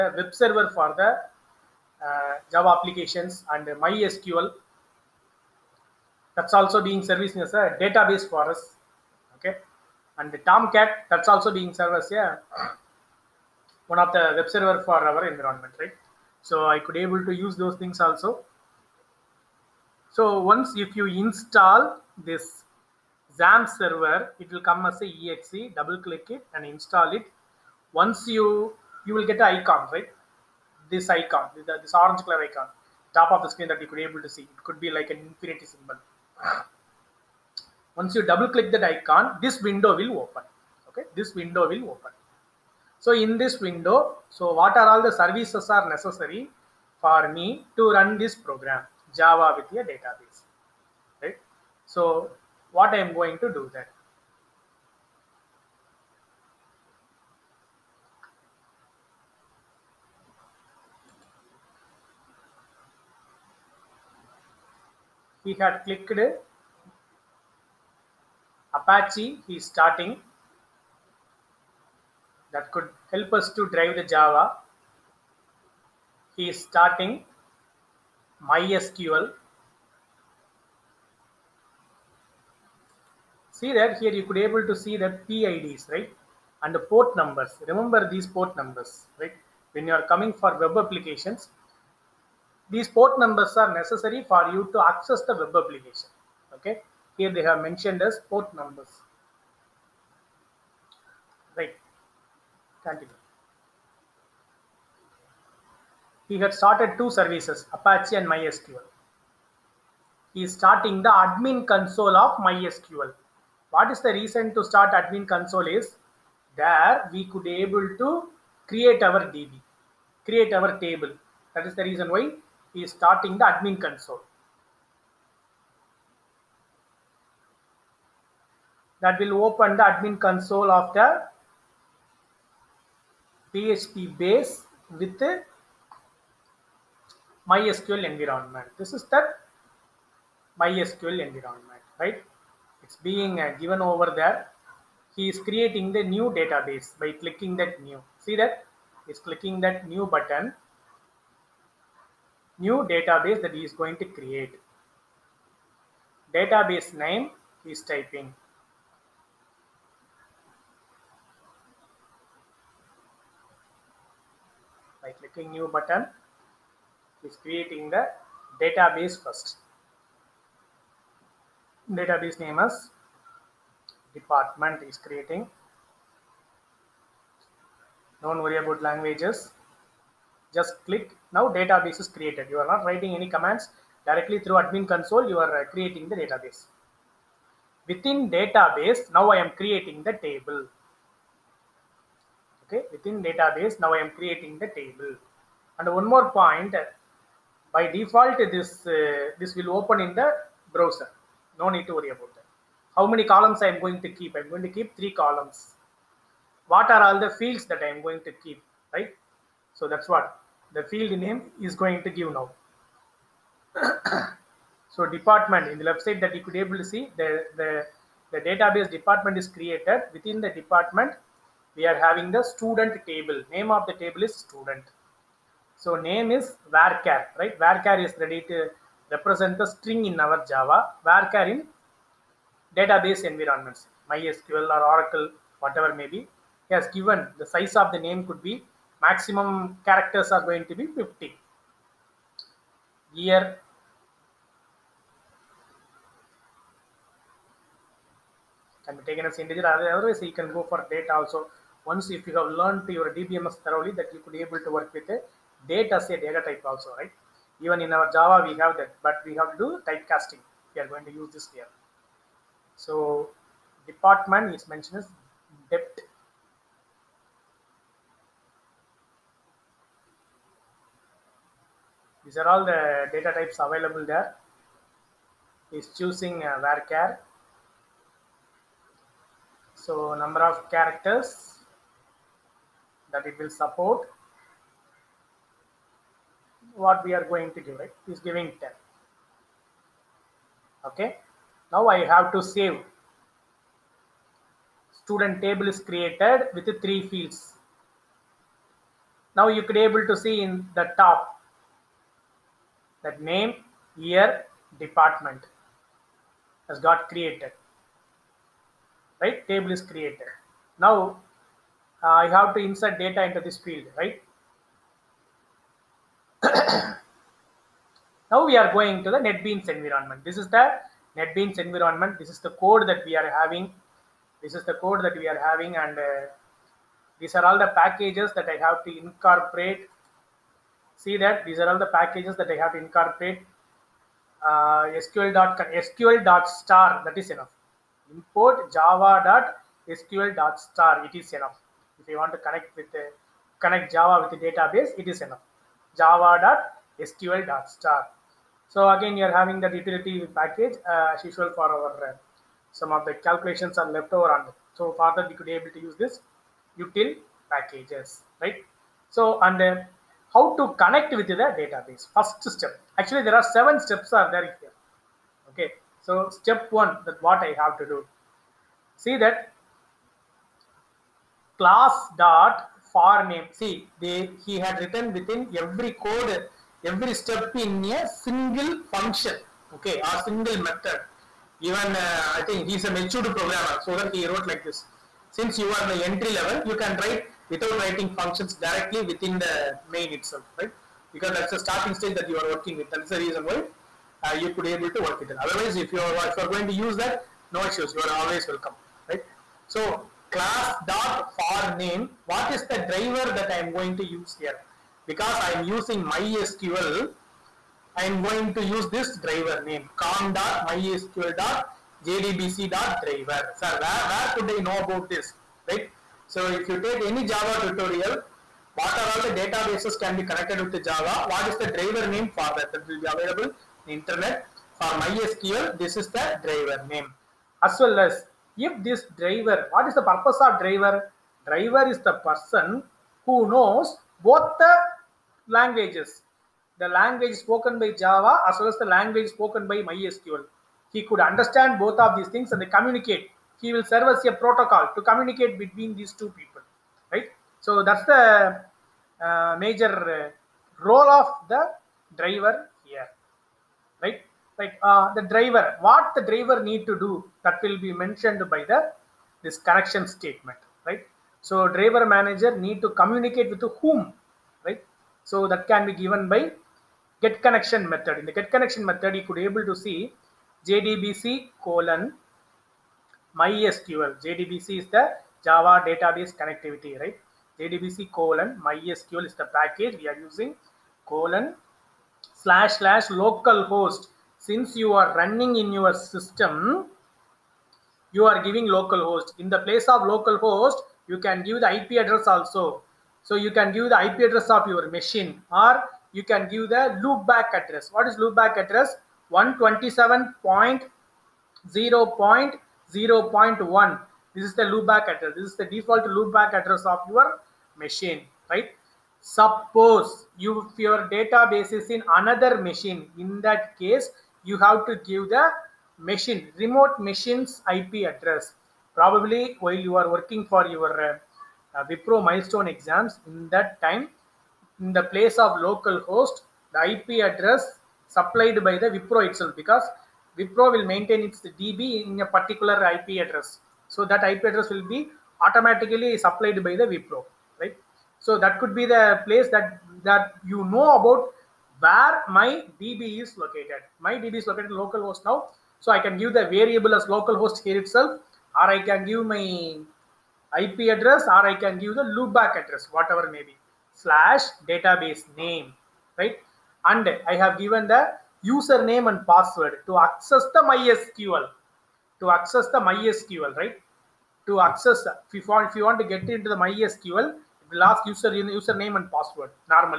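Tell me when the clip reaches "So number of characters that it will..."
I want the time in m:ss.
4:39.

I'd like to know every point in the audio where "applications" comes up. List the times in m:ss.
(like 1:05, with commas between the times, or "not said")
0:02, 1:30, 1:35.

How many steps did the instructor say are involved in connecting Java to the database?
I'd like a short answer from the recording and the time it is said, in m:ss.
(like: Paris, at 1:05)
7, at 6:03.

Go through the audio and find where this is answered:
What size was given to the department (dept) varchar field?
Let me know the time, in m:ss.
4:48.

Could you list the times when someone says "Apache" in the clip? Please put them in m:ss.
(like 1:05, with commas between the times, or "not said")
1:08, 1:47.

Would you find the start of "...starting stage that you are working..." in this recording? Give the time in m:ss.
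6:31.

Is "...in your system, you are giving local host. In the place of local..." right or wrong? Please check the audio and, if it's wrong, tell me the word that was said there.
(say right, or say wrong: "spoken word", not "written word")
right.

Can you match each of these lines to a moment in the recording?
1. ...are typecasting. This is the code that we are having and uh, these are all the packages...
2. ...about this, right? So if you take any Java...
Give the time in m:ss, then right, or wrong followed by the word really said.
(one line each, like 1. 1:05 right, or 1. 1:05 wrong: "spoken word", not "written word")
1. 5:23 wrong: "having", not "typecasting"
2. 6:54 right.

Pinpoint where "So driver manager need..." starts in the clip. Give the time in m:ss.
7:41.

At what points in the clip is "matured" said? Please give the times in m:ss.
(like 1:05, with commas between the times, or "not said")
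6:22.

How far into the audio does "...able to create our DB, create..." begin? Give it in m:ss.
1:57.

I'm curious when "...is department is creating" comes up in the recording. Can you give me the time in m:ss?
2:52.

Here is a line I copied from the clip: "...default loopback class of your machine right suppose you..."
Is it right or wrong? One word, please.
wrong.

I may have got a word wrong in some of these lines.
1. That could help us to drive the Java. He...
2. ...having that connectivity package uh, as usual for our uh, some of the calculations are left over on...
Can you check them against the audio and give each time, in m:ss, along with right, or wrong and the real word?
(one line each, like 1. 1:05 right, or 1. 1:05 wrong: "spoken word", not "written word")
1. 1:12 right
2. 5:49 wrong: "utility", not "connectivity".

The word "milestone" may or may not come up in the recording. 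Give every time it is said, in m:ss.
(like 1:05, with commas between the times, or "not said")
8:42.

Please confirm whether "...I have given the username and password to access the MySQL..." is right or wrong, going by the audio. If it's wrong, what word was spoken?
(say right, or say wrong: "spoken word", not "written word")
right.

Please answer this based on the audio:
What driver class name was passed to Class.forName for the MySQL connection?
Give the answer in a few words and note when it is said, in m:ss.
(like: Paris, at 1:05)
com.mysql.jdbc.driver, at 6:49.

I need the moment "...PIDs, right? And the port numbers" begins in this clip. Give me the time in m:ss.
1:25.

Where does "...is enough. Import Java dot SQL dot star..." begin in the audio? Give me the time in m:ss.
5:37.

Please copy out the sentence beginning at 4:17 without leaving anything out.
Even in our Java, we have that, but we have to do typecasting.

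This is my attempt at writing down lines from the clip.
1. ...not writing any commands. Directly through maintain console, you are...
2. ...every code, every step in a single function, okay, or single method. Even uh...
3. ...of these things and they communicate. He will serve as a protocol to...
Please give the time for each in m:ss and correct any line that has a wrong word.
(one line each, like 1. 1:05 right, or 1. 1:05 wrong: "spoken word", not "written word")
1. 3:02 wrong: "admin", not "maintain"
2. 6:15 right
3. 7:22 right.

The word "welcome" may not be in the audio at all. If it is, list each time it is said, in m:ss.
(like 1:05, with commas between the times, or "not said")
6:38.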